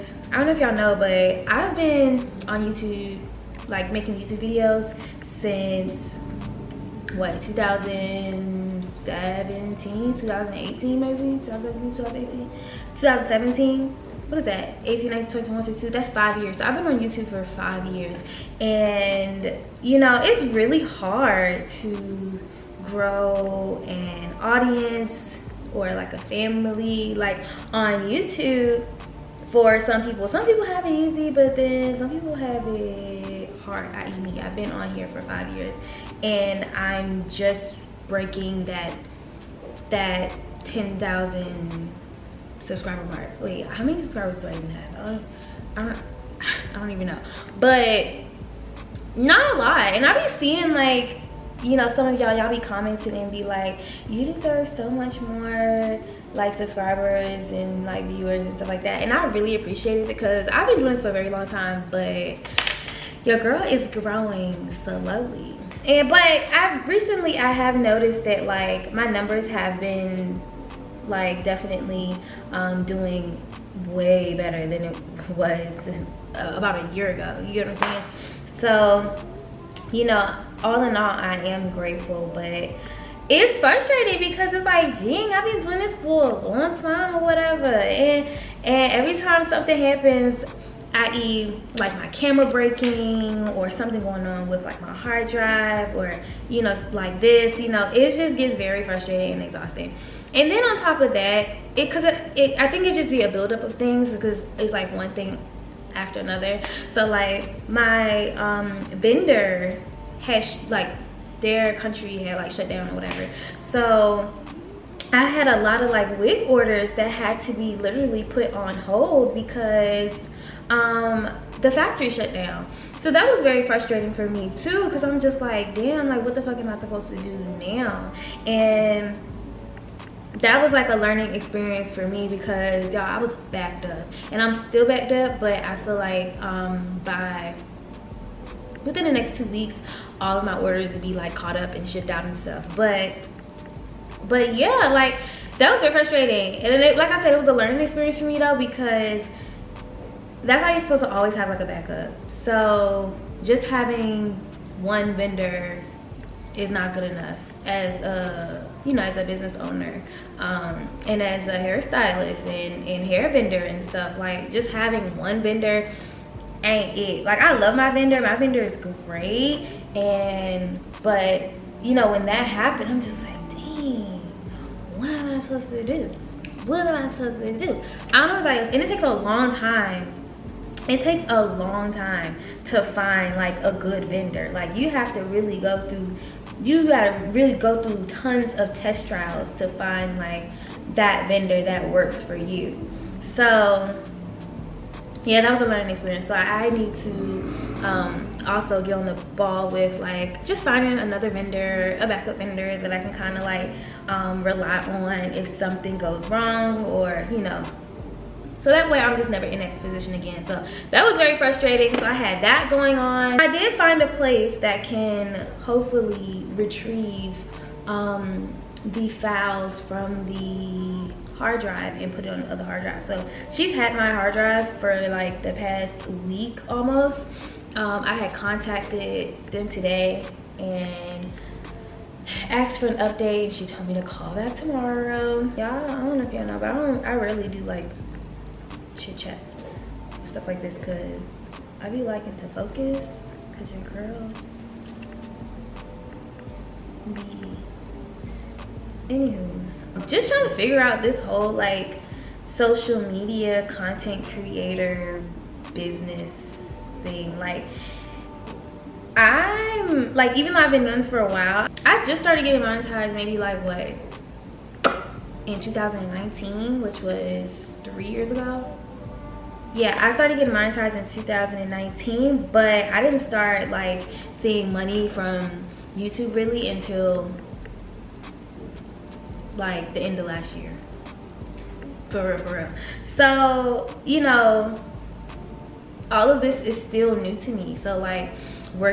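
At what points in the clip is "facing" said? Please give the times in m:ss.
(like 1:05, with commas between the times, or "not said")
not said.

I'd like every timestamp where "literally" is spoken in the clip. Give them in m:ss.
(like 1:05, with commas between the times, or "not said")
1:57.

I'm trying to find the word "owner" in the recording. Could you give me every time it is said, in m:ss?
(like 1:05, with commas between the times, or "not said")
2:39.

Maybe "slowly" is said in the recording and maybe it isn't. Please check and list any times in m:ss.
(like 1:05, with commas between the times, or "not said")
1:04.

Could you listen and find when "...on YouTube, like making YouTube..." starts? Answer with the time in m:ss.
0:02.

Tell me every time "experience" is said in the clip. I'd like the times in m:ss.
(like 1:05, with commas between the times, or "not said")
2:11, 2:27, 3:15.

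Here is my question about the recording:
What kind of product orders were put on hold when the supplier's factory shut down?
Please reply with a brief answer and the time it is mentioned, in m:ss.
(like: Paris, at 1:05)
Wig orders, at 1:56.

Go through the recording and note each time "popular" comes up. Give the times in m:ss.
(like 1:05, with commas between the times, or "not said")
not said.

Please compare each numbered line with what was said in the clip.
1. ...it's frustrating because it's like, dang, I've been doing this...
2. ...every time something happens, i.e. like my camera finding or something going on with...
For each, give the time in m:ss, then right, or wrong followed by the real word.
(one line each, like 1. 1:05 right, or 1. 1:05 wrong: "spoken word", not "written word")
1. 1:23 right
2. 1:28 wrong: "breaking", not "finding".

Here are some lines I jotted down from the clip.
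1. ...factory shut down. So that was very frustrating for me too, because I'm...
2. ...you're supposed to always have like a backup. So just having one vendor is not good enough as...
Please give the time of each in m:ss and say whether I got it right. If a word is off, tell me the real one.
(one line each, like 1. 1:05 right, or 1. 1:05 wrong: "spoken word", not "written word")
1. 2:01 right
2. 2:30 right.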